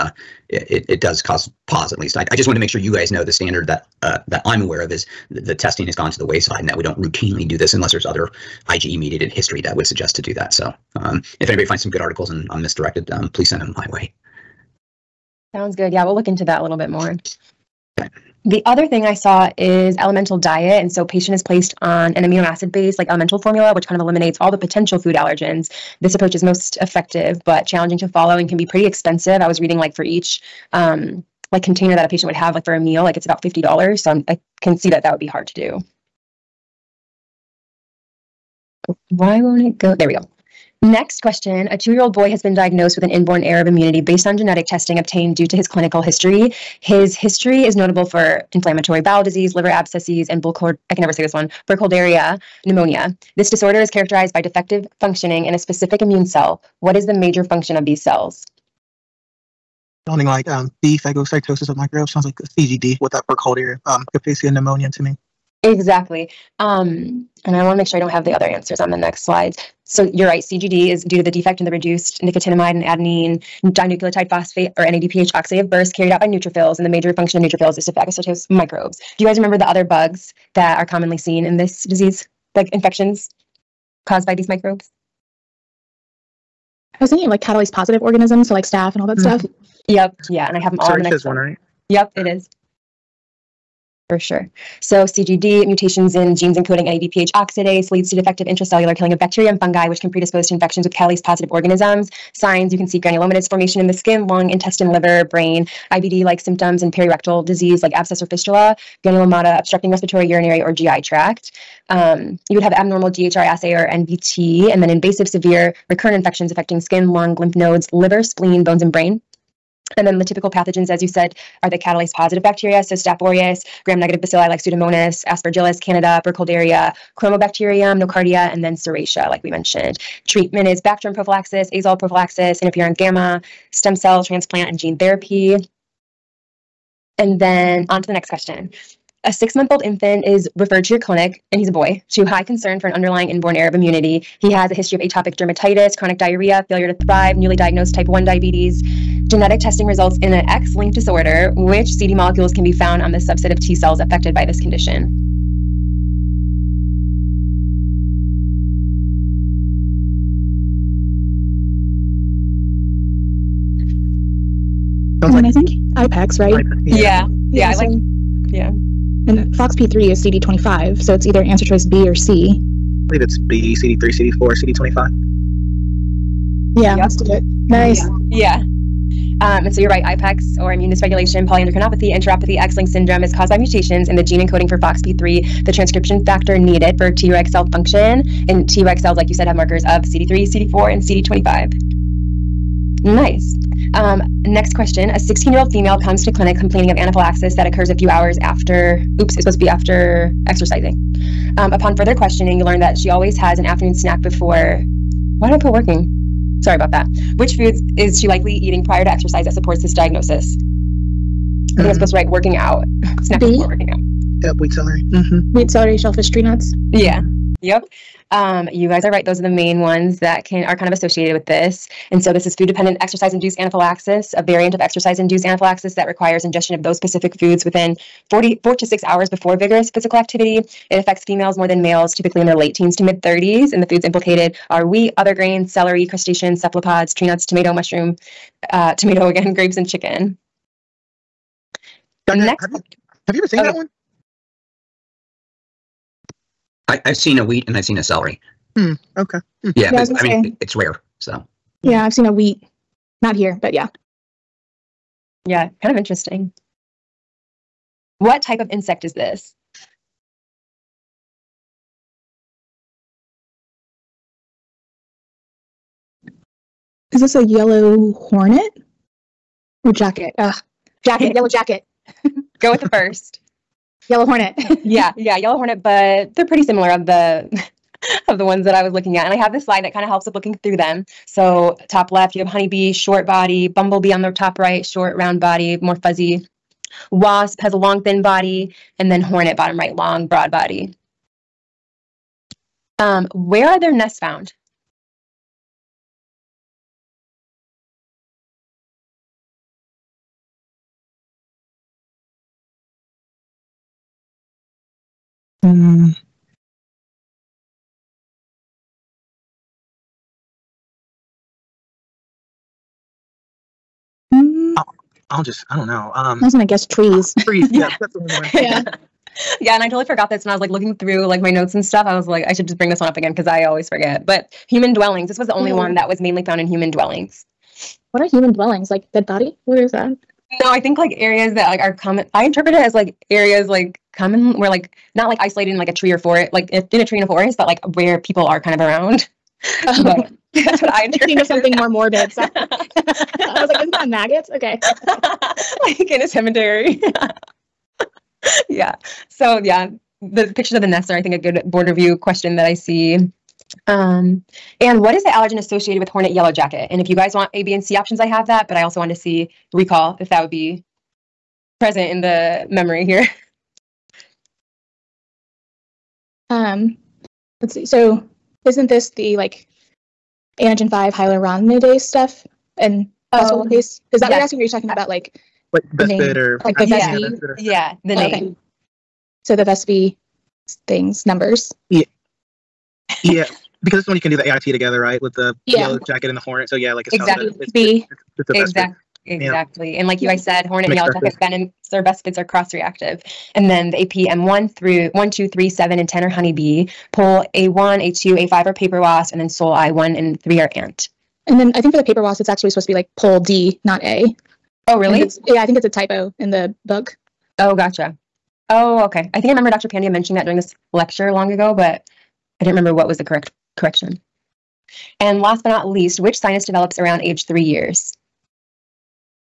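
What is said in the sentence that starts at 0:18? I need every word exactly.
The other thing I saw is elemental diet.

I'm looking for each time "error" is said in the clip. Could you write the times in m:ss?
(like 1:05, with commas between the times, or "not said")
0:43, 2:23.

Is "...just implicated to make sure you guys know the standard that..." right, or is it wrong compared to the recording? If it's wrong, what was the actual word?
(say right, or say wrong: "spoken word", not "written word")
wrong: "wanted", not "implicated".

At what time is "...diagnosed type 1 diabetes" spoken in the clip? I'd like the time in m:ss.
2:27.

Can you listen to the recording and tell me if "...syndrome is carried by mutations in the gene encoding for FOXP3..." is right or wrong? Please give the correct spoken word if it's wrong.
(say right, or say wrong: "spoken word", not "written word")
wrong: "caused", not "carried".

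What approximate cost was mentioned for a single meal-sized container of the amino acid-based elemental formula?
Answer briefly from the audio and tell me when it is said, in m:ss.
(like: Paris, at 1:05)
$50, at 0:33.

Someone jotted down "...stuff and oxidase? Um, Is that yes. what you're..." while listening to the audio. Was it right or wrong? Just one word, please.
wrong.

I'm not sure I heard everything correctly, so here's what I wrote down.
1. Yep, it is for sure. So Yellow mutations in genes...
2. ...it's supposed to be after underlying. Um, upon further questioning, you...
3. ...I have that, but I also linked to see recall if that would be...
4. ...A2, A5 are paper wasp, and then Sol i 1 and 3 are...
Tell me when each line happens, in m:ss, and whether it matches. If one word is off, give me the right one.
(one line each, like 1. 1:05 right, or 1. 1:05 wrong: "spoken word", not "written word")
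1. 1:31 wrong: "CGD", not "Yellow"
2. 3:19 wrong: "exercising", not "underlying"
3. 5:58 wrong: "wanted", not "linked"
4. 6:38 right.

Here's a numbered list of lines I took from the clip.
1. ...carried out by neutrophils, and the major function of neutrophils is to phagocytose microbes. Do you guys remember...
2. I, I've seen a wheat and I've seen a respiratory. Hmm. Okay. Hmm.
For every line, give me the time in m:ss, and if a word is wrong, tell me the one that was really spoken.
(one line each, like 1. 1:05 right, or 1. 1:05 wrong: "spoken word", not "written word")
1. 1:15 right
2. 4:06 wrong: "celery", not "respiratory".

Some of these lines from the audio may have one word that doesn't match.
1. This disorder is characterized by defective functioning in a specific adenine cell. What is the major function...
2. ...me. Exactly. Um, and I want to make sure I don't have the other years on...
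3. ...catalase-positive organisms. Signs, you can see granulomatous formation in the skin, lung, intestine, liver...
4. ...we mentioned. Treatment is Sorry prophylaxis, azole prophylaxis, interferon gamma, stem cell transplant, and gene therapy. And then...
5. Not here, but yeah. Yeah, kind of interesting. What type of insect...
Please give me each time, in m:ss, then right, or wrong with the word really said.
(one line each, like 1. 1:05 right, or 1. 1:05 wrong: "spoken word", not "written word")
1. 0:53 wrong: "immune", not "adenine"
2. 1:05 wrong: "answers", not "years"
3. 1:40 right
4. 2:09 wrong: "Bactrim", not "Sorry"
5. 4:13 right.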